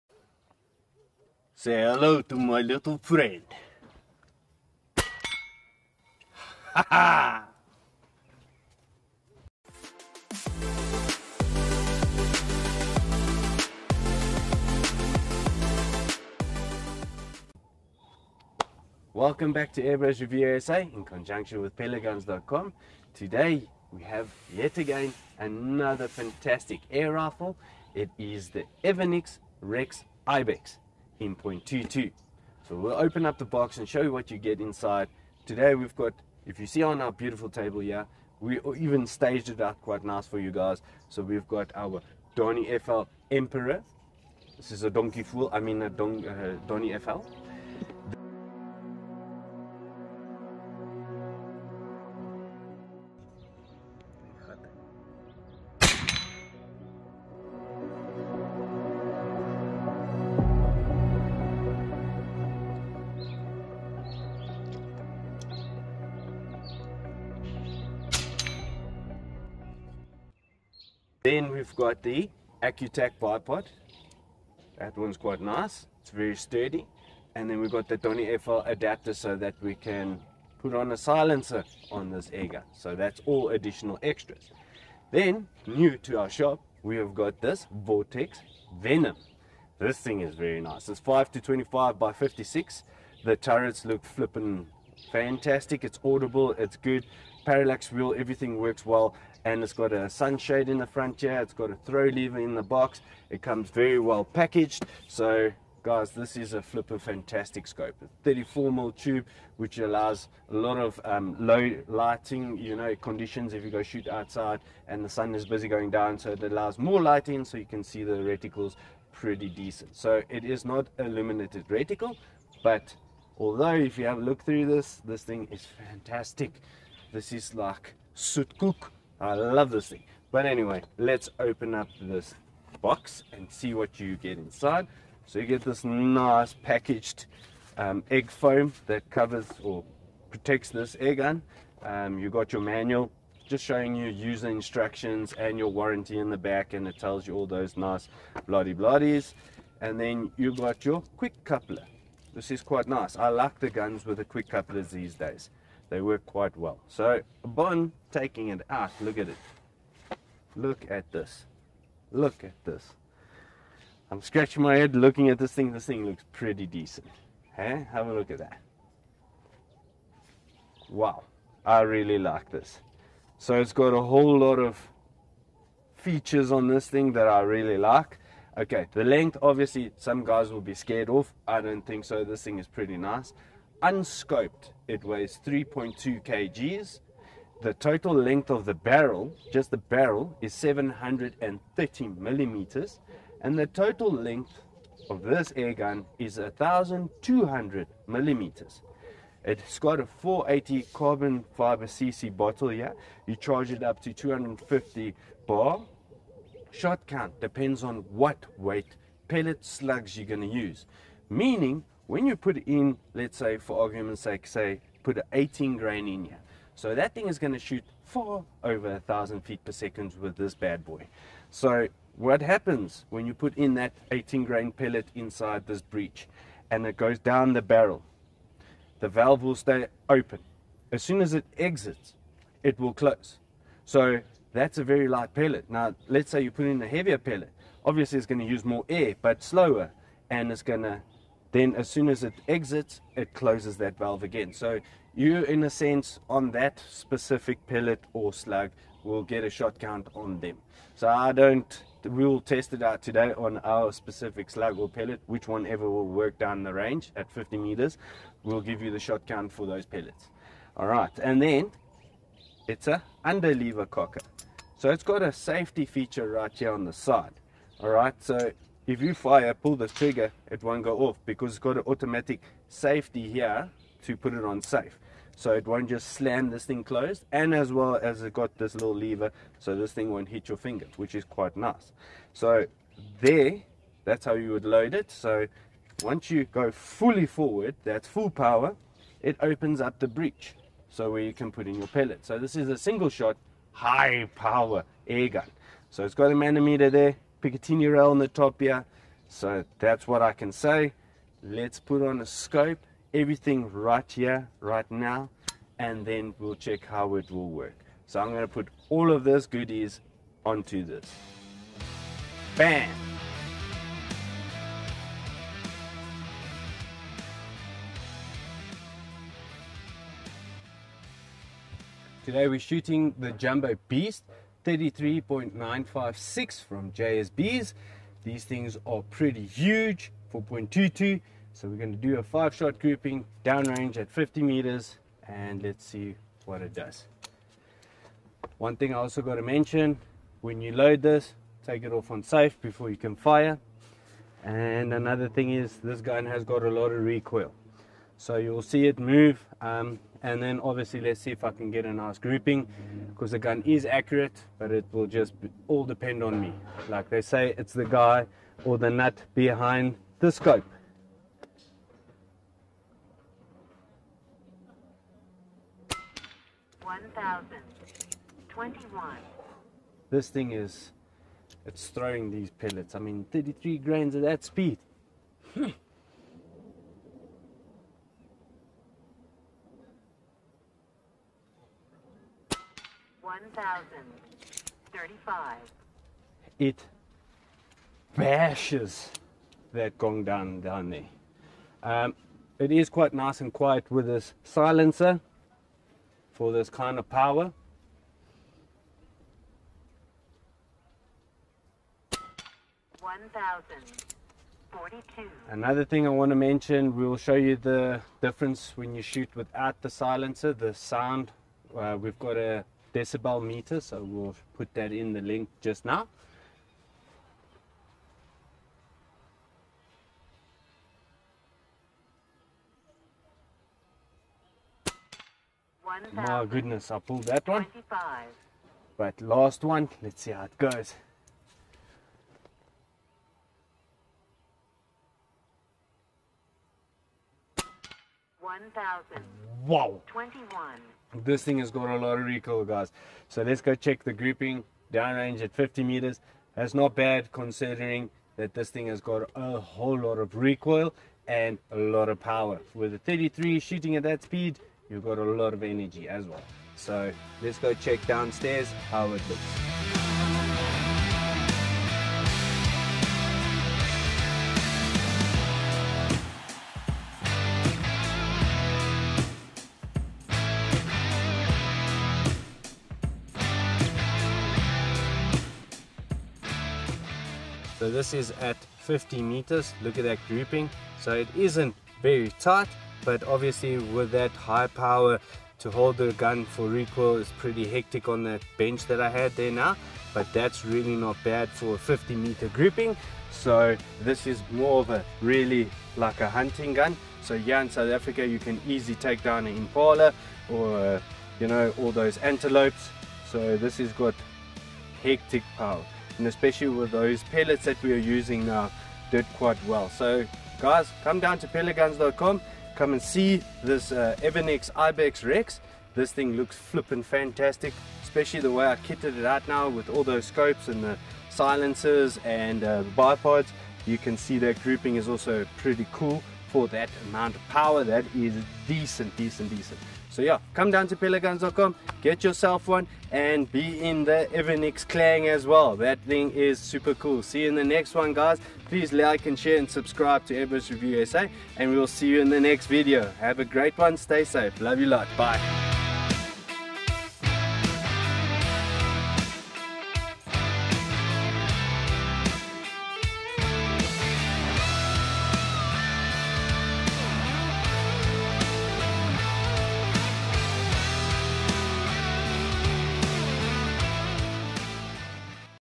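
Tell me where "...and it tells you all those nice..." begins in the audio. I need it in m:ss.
2:26.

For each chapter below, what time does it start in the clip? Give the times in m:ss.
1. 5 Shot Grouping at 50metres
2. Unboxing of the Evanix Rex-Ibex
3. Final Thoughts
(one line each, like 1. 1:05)
1. 5:22
2. 0:18
3. 8:00.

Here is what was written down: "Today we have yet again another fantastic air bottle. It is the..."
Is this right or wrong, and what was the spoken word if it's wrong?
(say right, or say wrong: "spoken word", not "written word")
wrong: "rifle", not "bottle".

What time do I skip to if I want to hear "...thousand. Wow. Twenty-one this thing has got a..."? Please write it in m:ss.
7:18.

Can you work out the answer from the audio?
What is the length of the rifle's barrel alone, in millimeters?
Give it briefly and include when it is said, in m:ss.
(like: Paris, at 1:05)
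730 mm, at 3:10.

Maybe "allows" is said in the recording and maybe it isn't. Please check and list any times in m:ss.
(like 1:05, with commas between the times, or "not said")
1:49, 1:56.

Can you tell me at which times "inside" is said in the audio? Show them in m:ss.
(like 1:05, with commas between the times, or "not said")
0:34, 2:14, 3:45.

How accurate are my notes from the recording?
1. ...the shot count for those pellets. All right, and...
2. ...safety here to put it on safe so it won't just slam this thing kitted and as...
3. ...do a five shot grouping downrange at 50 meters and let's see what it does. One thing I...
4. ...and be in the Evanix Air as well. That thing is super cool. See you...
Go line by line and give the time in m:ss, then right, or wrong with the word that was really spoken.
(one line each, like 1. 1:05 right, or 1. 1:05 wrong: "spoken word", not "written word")
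1. 4:18 right
2. 4:32 wrong: "closed", not "kitted"
3. 5:31 right
4. 8:53 wrong: "Clang", not "Air".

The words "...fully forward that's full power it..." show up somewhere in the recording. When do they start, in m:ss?
4:46.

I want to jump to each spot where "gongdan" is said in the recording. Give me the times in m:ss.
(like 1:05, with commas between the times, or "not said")
6:29.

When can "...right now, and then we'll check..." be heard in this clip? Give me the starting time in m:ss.
5:04.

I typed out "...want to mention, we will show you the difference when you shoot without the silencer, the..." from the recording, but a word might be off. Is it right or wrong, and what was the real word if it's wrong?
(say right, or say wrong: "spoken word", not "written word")
right.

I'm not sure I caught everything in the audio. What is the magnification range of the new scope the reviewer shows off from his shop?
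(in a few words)
5 to 25.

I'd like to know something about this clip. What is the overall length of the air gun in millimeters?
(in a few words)
1,200 mm.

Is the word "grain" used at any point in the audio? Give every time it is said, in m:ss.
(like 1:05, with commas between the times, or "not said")
3:35, 3:44, 6:13.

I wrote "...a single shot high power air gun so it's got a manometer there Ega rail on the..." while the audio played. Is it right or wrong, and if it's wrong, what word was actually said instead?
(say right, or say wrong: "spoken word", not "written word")
wrong: "Picatinny", not "Ega".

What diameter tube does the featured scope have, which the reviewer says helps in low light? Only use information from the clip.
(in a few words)
34 mm.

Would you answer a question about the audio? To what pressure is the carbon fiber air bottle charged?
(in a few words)
250 bar.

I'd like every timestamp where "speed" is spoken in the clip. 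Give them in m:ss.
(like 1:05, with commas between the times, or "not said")
6:14, 7:34.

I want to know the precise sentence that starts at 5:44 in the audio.
And another thing is this gun has got a lot of recoil.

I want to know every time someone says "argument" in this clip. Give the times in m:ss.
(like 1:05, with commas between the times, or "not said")
3:33.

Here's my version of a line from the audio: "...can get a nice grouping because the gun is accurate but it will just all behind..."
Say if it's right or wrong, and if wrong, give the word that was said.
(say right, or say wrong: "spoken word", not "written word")
wrong: "depend", not "behind".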